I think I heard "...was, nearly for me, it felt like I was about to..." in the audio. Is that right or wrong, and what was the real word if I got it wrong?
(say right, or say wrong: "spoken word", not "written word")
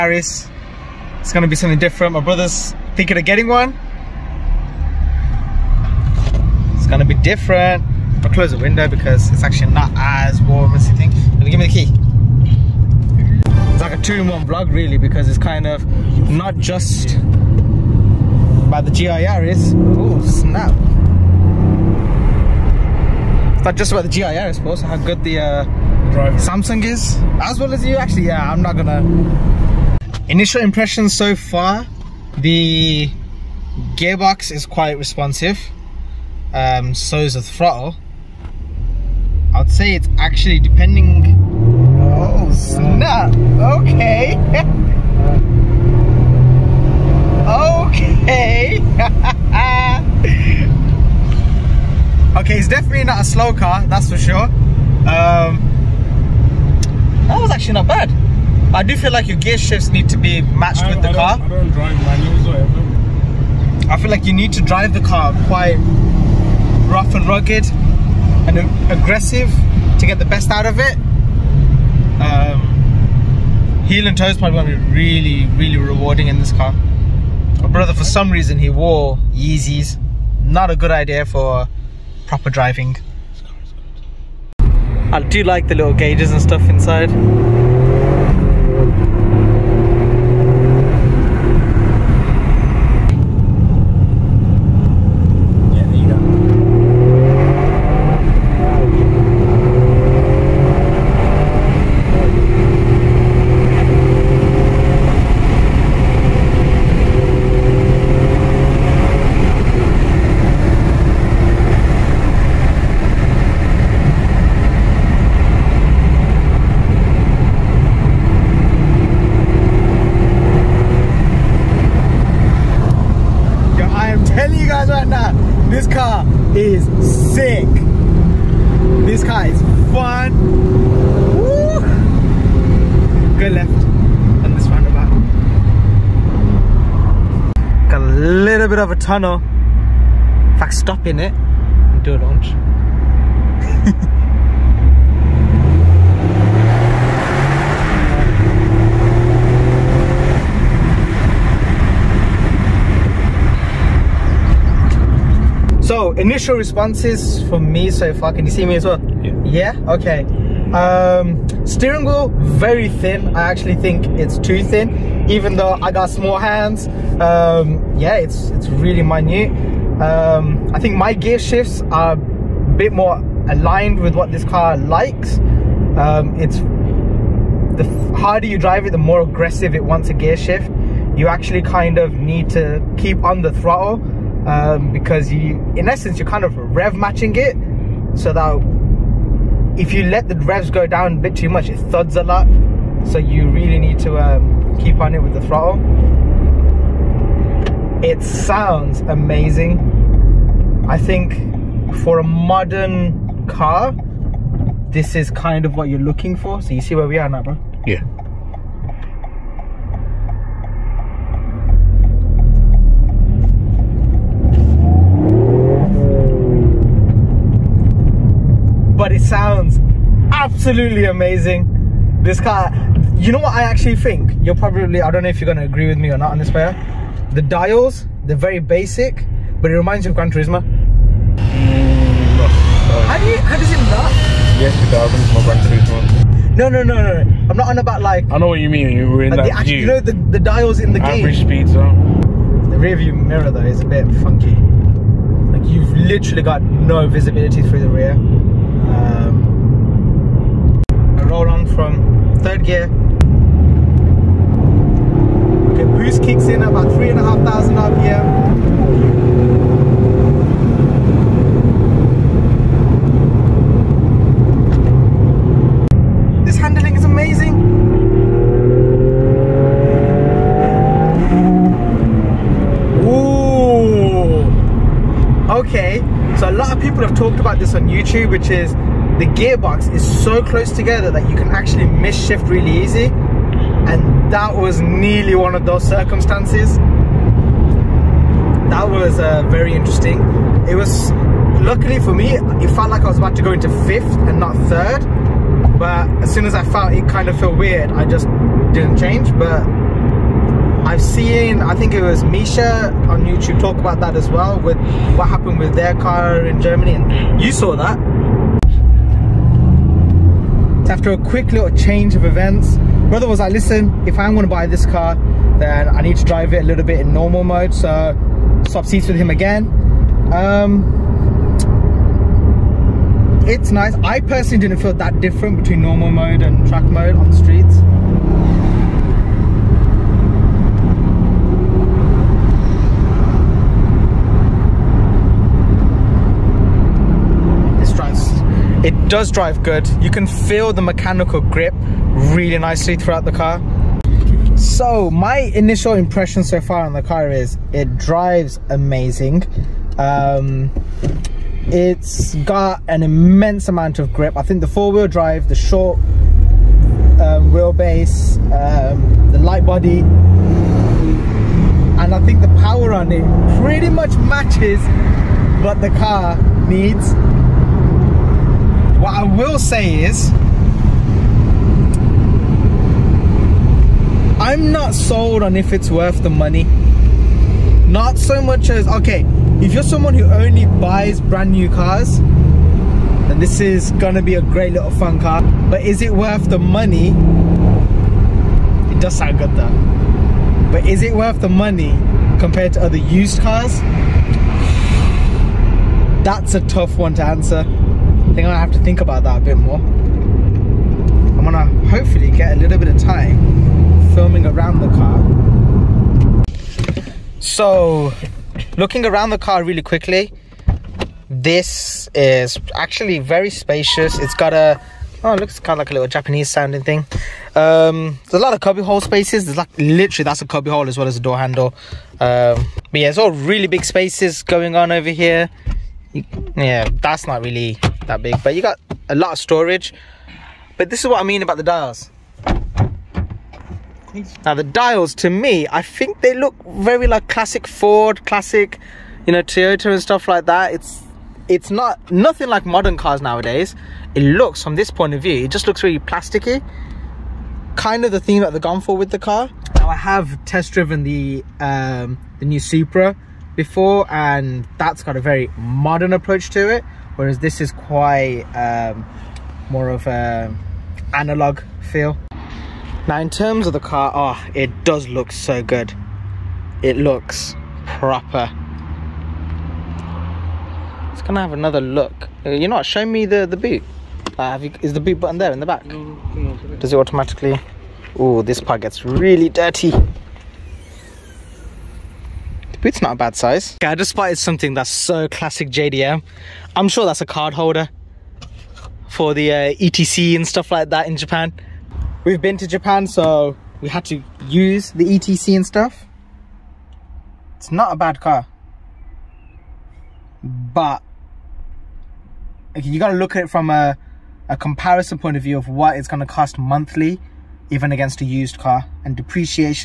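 wrong: "luckily", not "nearly".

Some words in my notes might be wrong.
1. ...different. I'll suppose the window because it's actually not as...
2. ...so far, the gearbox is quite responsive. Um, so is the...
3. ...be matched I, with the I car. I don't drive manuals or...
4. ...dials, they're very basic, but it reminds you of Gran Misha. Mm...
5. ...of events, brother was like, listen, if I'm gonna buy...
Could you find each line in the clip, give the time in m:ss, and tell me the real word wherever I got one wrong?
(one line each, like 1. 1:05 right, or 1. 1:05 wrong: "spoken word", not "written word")
1. 0:07 wrong: "close", not "suppose"
2. 0:31 right
3. 1:00 right
4. 3:47 wrong: "Turismo", not "Misha"
5. 5:12 right.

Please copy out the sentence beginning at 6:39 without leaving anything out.
I'm gonna hopefully get a little bit of time filming around the car.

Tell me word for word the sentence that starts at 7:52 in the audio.
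Uh, you're not showing me the, the boot.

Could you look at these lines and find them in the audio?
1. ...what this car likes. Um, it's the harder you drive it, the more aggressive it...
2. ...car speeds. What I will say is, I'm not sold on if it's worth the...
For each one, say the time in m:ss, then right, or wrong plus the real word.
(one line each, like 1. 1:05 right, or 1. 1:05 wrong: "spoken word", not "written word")
1. 2:54 right
2. 6:06 wrong: "needs", not "speeds".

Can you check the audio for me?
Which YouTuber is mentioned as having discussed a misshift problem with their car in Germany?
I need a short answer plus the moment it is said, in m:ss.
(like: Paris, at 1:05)
Misha, at 5:02.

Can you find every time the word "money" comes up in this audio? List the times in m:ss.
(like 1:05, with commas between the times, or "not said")
6:16, 6:26, 6:31.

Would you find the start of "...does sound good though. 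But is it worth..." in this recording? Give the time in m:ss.
6:29.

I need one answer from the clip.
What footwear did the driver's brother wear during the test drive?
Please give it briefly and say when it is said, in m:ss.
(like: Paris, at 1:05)
Yeezys, at 1:19.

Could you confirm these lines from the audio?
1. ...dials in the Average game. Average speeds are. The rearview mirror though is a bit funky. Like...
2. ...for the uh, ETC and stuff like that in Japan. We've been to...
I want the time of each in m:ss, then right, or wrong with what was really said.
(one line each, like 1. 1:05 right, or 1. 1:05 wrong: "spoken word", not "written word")
1. 4:00 right
2. 8:09 right.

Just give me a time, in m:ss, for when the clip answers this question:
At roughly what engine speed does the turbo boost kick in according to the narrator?
4:16.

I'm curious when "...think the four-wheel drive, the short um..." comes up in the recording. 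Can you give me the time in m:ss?
5:54.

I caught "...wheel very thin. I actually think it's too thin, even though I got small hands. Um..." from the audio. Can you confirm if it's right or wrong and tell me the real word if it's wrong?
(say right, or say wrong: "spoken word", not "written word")
right.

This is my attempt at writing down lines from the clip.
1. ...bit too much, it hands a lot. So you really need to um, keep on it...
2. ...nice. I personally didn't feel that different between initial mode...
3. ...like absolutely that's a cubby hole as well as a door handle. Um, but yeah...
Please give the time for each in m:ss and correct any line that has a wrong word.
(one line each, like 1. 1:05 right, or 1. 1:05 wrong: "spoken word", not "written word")
1. 3:11 wrong: "thuds", not "hands"
2. 5:23 wrong: "normal", not "initial"
3. 6:59 wrong: "literally", not "absolutely".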